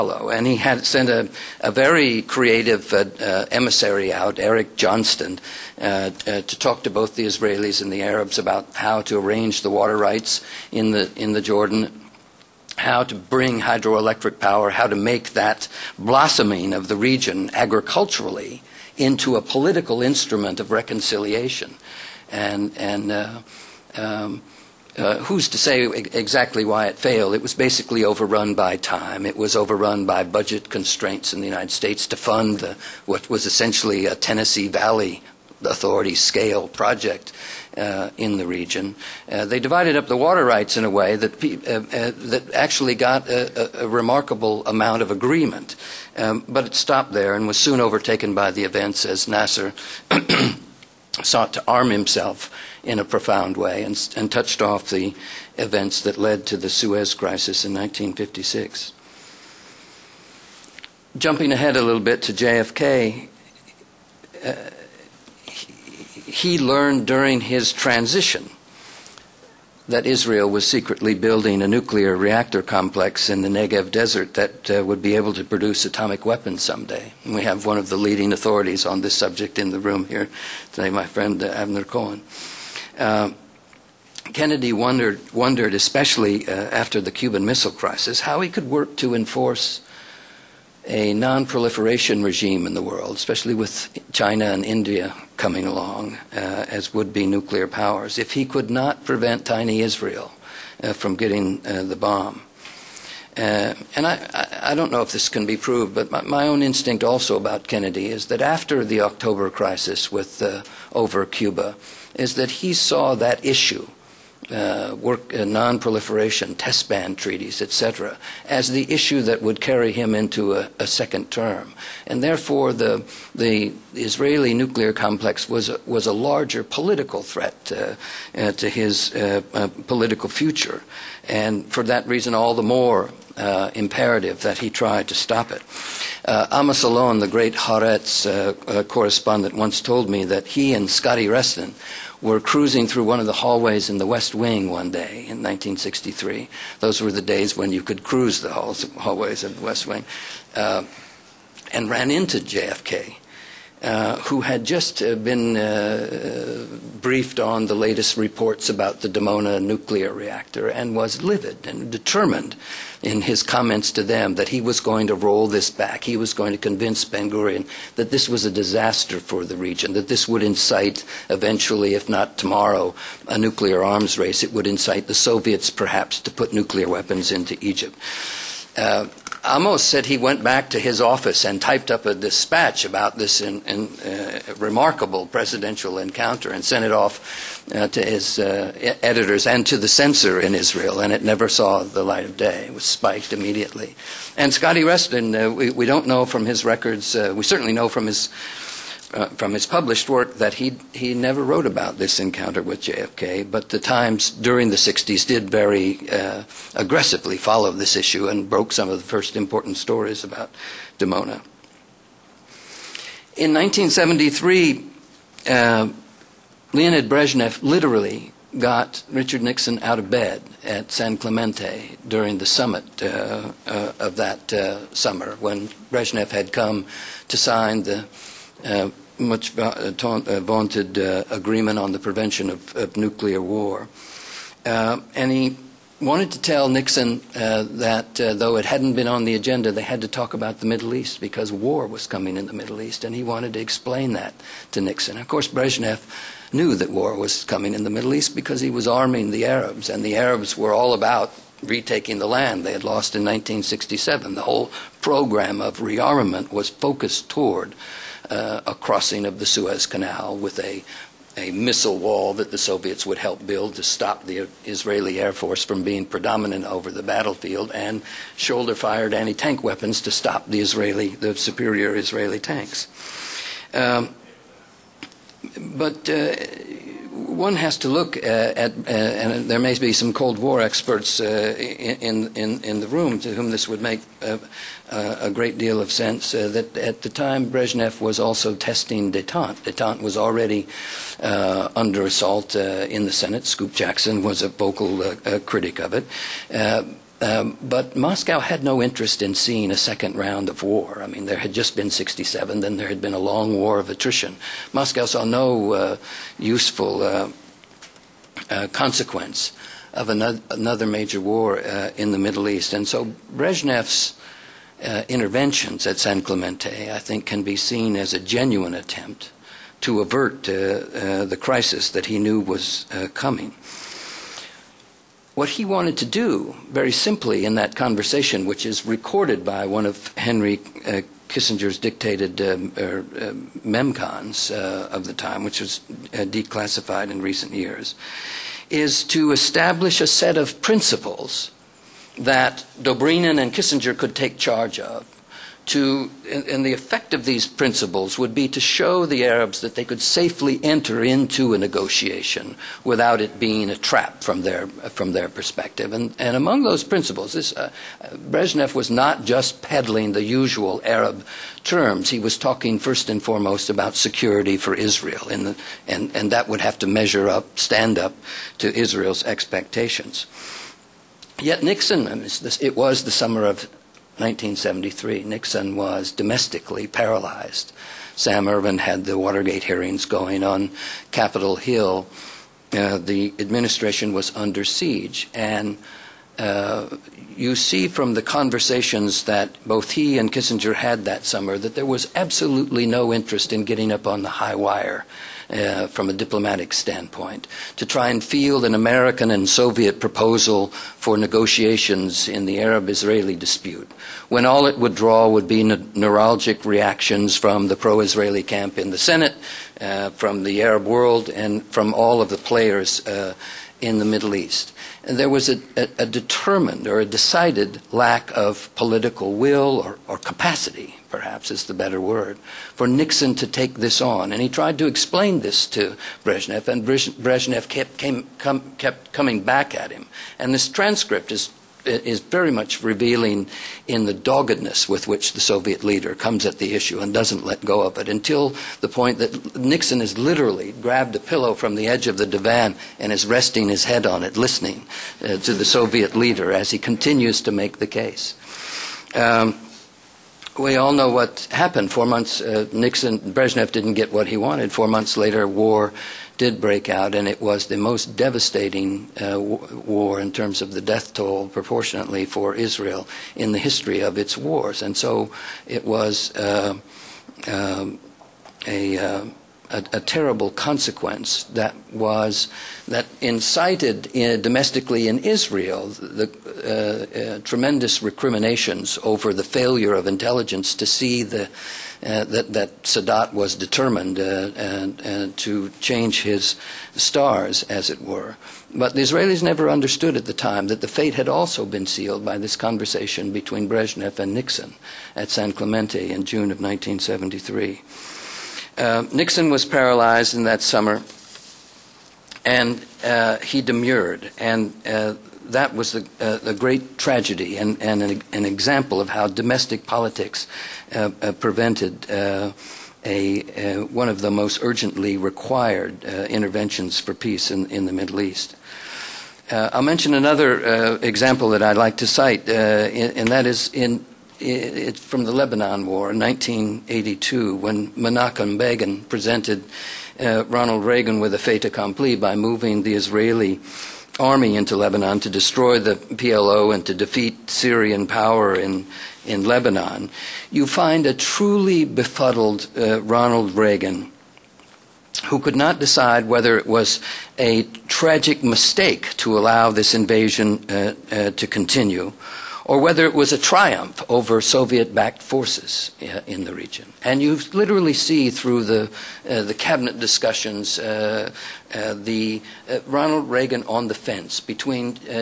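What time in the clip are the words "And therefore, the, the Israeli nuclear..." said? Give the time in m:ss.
2:02.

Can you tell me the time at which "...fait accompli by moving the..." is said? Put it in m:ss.
8:51.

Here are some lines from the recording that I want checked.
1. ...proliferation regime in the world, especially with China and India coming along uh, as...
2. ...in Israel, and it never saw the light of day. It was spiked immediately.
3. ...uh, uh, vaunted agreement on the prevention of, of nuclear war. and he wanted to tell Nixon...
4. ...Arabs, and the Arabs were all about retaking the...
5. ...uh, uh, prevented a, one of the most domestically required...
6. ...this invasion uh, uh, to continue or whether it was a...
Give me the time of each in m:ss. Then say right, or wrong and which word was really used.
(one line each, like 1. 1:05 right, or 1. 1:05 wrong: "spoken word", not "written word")
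1. 1:31 right
2. 3:10 right
3. 3:49 right
4. 4:09 right
5. 8:30 wrong: "urgently", not "domestically"
6. 9:09 right.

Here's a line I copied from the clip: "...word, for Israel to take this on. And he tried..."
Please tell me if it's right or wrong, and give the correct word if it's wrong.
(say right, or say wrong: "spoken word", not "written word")
wrong: "Nixon", not "Israel".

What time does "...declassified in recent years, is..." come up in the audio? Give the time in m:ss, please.
5:36.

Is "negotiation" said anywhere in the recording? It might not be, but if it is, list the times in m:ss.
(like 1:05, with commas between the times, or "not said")
5:51, 6:41.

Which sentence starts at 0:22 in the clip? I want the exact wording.
And, and uh, um, uh, who's to say exactly why it failed?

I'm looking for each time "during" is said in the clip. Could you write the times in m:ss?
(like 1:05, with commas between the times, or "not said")
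1:07, 3:24, 3:42.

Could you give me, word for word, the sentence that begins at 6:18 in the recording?
Sam Ervin had the Watergate hearings going on Capitol Hill.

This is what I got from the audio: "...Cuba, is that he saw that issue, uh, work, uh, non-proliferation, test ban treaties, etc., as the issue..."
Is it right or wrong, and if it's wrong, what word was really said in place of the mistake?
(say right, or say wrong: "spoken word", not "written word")
right.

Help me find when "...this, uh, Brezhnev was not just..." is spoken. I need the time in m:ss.
5:57.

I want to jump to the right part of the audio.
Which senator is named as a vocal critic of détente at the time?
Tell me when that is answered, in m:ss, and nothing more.
4:53.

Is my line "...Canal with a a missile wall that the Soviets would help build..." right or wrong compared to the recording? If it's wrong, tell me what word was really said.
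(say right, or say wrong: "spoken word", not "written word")
right.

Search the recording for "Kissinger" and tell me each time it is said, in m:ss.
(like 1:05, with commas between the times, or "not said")
5:31, 5:43, 6:30.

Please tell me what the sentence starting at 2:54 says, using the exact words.
It would incite the Soviets perhaps to put nuclear weapons into Egypt.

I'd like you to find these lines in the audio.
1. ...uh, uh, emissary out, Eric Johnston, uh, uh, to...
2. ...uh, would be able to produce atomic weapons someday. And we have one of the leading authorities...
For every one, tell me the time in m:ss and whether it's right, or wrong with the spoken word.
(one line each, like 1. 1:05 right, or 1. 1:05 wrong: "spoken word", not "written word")
1. 0:02 right
2. 1:14 right.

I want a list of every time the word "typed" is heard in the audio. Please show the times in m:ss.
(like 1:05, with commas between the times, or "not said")
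3:01.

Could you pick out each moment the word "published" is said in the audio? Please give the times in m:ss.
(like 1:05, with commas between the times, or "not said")
3:19.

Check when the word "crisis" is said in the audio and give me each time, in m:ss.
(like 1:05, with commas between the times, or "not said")
0:57, 1:27, 1:49, 5:21.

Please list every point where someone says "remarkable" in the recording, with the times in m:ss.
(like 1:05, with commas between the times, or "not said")
0:43, 3:04.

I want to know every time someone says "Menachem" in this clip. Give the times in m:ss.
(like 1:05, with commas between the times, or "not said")
8:47.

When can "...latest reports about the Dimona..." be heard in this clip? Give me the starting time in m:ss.
2:37.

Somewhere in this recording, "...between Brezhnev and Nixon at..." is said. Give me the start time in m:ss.
8:13.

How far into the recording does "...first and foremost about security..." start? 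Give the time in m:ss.
6:02.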